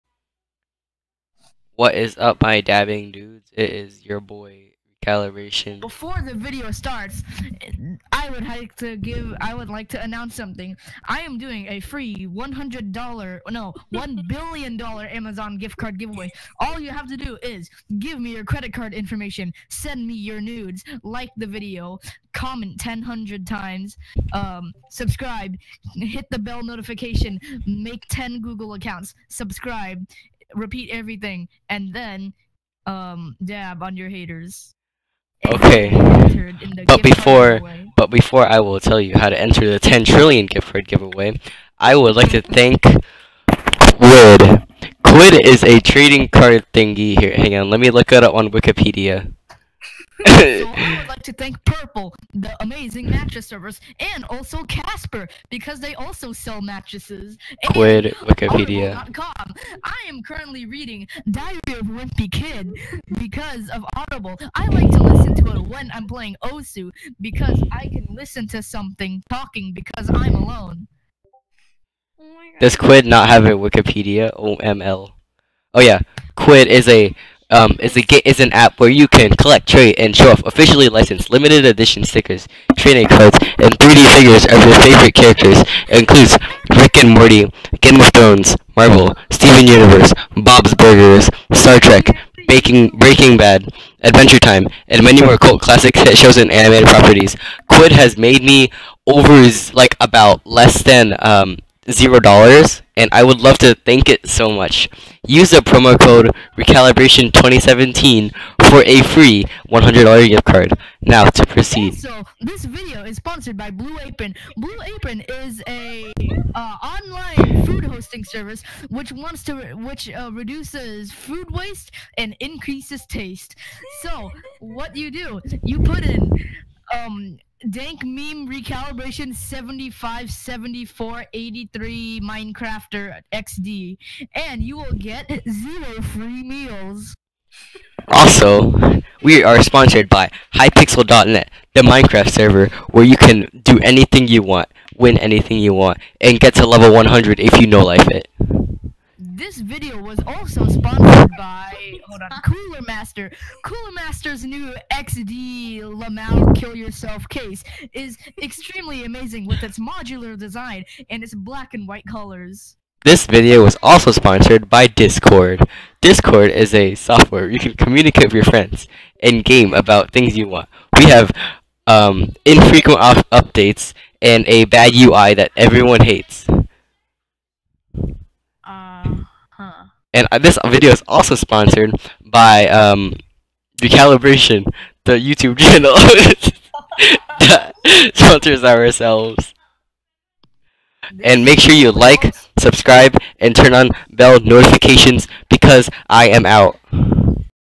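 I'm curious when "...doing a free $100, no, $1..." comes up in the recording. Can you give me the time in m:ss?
0:11.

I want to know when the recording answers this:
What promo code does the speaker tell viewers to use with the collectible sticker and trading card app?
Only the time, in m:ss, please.
1:46.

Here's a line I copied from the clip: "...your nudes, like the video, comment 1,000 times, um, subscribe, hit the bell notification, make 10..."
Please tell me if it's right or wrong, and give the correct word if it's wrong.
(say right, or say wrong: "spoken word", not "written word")
right.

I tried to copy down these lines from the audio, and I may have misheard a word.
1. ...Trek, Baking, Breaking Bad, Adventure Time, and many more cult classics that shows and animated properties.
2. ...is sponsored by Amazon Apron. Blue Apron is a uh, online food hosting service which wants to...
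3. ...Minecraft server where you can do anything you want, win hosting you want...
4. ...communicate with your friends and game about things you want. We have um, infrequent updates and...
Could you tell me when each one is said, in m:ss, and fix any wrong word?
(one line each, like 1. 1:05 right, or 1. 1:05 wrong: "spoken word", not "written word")
1. 1:31 right
2. 1:53 wrong: "Blue", not "Amazon"
3. 2:21 wrong: "anything", not "hosting"
4. 2:47 right.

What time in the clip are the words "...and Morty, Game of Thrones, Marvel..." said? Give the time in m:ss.
1:26.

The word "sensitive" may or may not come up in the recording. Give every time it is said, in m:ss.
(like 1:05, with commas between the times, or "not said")
not said.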